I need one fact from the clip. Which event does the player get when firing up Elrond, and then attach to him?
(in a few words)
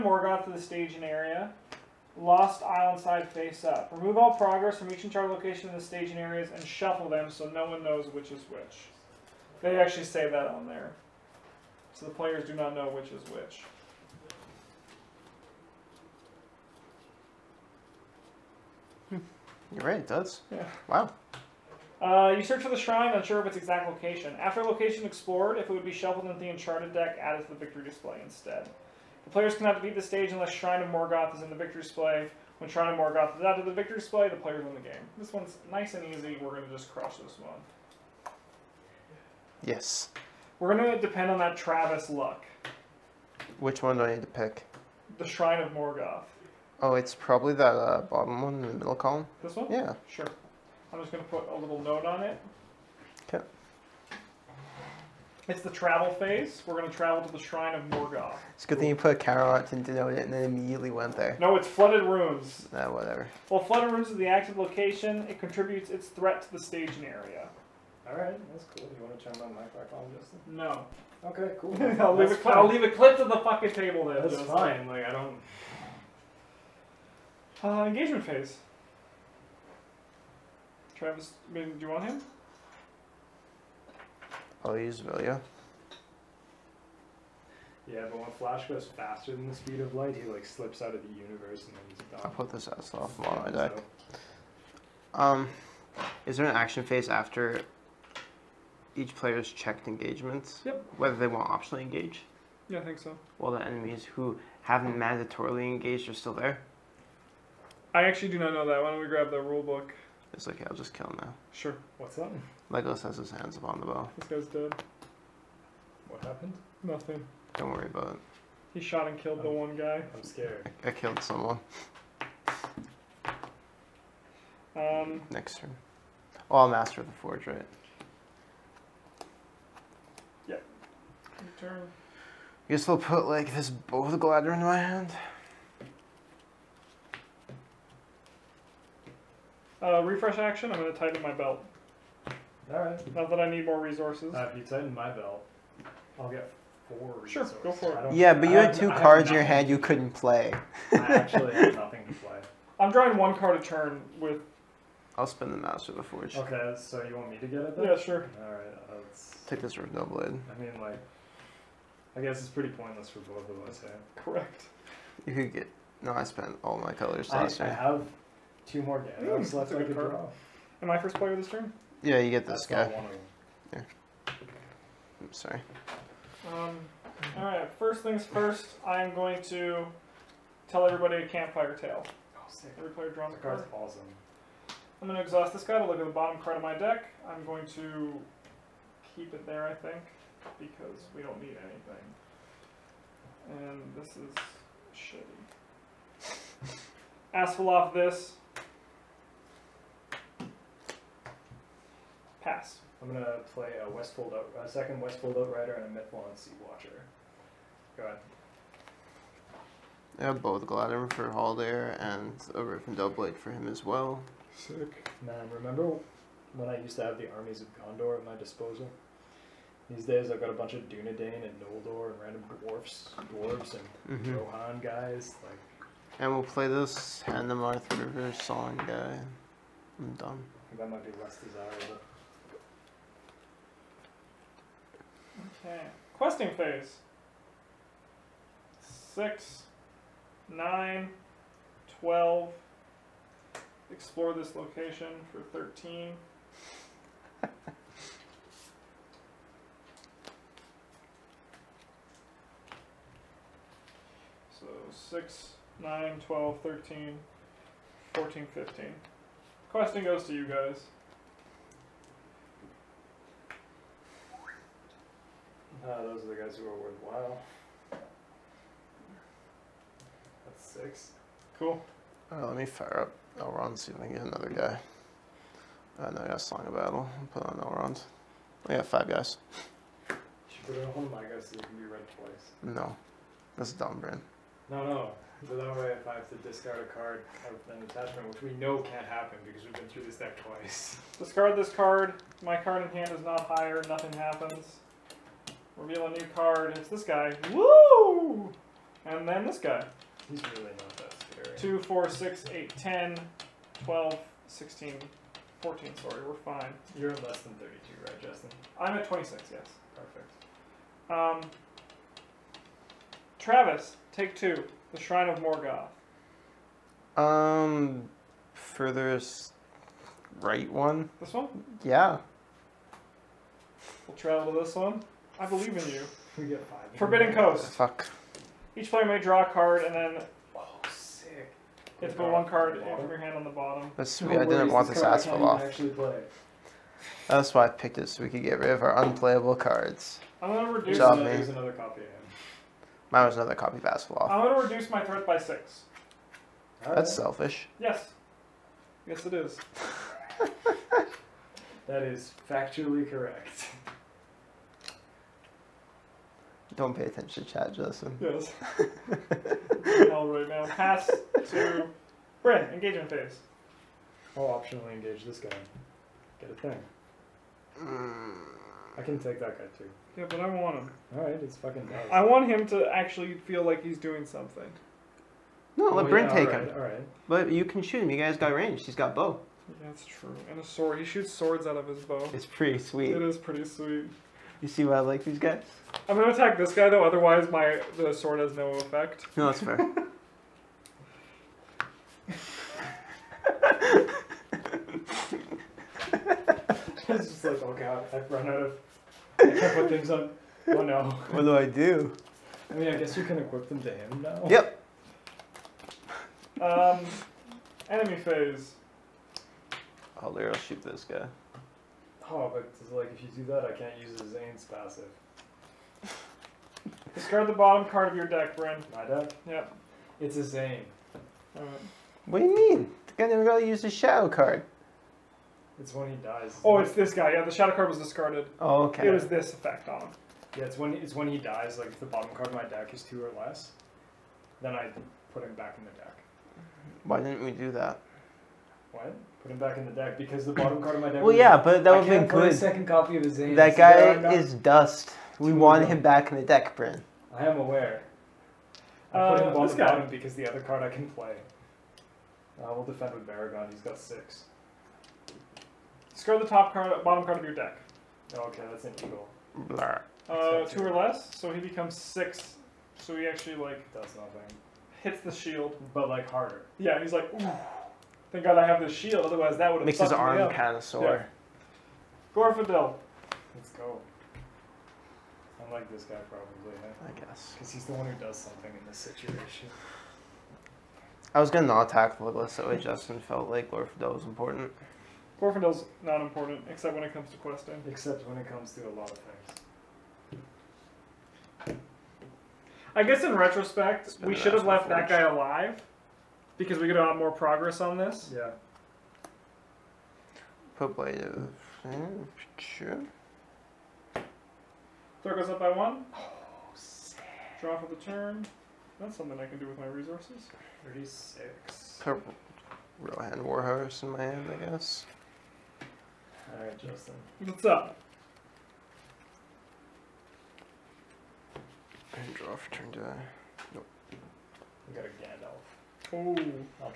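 Song of Battle.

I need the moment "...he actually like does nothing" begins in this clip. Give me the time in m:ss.
7:43.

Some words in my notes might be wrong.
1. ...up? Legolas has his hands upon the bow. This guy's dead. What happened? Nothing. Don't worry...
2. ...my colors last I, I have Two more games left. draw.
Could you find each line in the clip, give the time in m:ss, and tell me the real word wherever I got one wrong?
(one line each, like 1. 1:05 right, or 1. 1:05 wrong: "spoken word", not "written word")
1. 1:52 right
2. 2:46 right.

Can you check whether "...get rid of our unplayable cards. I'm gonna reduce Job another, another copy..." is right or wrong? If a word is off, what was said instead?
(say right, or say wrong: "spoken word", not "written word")
right.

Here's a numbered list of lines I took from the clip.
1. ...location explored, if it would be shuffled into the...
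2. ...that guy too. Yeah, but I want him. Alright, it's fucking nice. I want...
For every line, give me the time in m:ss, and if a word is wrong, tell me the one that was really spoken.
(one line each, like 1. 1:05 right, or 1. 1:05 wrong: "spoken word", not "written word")
1. 0:24 right
2. 6:09 right.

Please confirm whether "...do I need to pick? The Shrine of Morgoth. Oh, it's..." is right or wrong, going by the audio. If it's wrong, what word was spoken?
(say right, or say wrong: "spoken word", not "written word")
right.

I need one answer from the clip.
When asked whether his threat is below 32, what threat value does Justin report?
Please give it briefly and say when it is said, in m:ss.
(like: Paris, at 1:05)
26, at 5:09.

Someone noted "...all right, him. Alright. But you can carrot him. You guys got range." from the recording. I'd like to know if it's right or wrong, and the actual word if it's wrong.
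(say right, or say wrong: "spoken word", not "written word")
wrong: "shoot", not "carrot".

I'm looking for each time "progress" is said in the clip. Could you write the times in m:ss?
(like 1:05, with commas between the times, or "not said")
0:04, 8:17.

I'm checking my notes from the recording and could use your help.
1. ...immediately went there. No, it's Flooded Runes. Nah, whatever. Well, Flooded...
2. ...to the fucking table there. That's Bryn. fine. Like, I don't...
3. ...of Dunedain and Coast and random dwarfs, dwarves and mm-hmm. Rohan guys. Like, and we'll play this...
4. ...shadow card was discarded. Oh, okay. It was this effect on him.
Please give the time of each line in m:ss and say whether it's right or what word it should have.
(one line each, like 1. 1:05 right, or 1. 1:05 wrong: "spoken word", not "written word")
1. 1:00 right
2. 1:13 wrong: "Justin", not "Bryn"
3. 3:40 wrong: "Noldor", not "Coast"
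4. 7:07 right.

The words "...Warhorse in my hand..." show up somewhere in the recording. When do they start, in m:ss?
8:33.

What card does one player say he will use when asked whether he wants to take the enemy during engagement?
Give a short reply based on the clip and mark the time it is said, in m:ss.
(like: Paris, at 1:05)
Velia, at 1:25.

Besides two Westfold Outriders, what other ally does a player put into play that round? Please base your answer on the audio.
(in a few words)
Mithlond Sea Watcher.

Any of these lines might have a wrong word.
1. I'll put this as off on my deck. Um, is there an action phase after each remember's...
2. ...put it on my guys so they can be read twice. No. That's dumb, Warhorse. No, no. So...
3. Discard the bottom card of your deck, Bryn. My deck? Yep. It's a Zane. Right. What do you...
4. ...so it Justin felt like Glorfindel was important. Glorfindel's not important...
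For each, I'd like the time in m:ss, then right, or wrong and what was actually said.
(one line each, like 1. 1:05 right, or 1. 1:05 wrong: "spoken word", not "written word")
1. 1:32 wrong: "player", not "remember"
2. 4:40 wrong: "Brand", not "Warhorse"
3. 6:57 right
4. 8:02 right.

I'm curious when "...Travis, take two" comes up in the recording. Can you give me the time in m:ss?
5:13.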